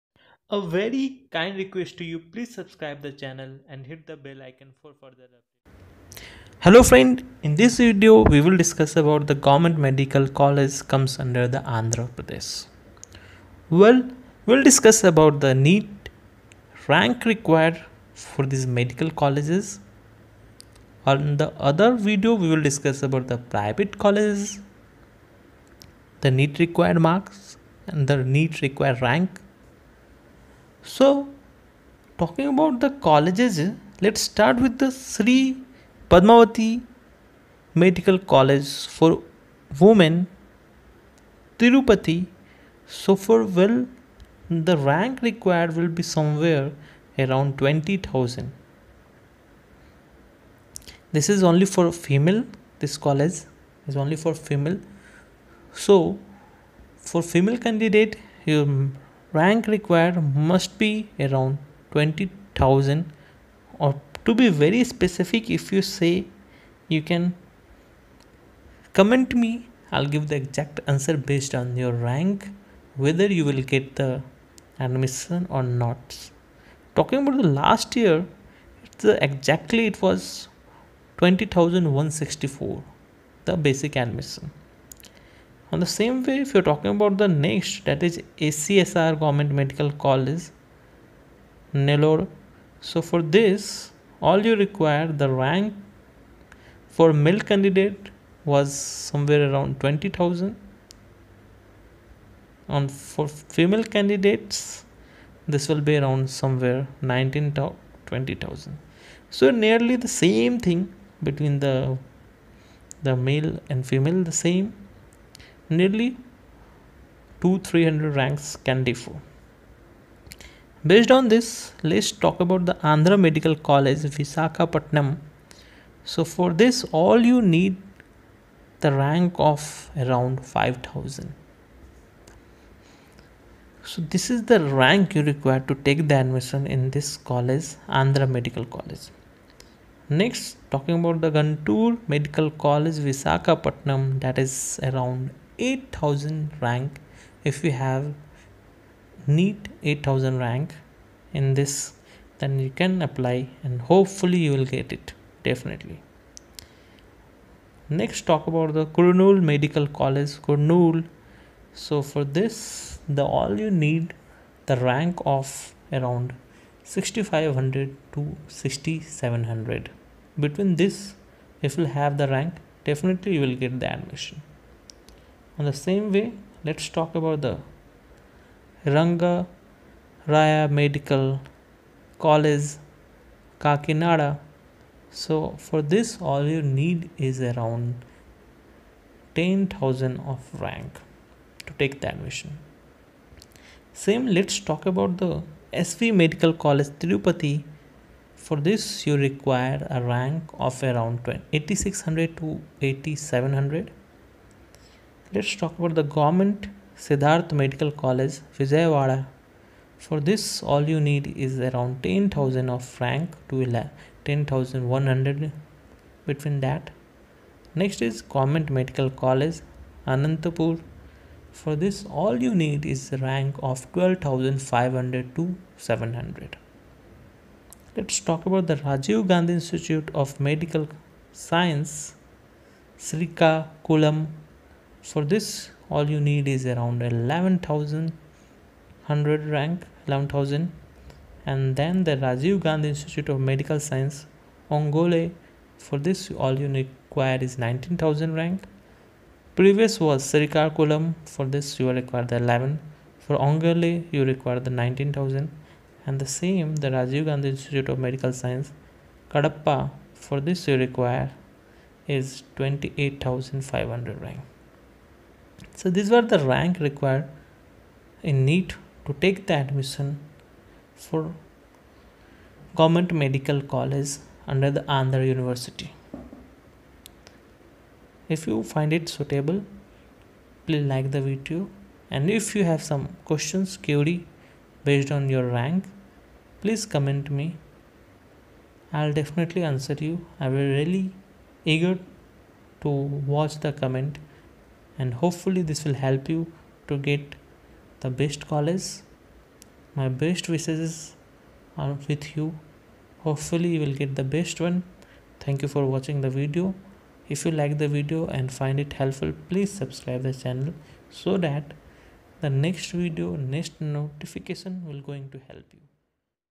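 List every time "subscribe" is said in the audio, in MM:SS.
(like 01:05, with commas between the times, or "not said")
00:02, 05:09.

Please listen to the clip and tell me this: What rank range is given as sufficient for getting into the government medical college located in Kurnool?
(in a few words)
6500 to 6700.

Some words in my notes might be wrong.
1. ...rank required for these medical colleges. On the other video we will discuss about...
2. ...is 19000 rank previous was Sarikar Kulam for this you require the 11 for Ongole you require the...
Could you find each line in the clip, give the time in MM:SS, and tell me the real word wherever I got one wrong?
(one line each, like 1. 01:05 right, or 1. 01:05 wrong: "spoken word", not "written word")
1. 00:16 right
2. 04:07 right.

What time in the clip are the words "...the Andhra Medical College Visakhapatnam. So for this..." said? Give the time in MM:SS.
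02:02.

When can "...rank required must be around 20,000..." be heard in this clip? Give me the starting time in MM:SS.
00:59.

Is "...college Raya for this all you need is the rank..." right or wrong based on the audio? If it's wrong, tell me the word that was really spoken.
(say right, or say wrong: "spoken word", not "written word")
wrong: "Anantapur", not "Raya".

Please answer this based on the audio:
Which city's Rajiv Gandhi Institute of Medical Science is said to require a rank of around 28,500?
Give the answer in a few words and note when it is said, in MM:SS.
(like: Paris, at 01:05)
Kadapa, at 04:19.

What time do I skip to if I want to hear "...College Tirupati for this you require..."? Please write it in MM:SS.
03:16.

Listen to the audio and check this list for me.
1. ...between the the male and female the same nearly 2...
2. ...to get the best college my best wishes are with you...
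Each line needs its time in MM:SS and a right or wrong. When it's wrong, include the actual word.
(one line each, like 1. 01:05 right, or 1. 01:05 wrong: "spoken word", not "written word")
1. 01:51 right
2. 04:56 right.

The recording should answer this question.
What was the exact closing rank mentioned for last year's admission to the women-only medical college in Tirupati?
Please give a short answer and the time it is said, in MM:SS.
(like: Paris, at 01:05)
20,164, at 01:21.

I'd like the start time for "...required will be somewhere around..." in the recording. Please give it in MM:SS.
00:45.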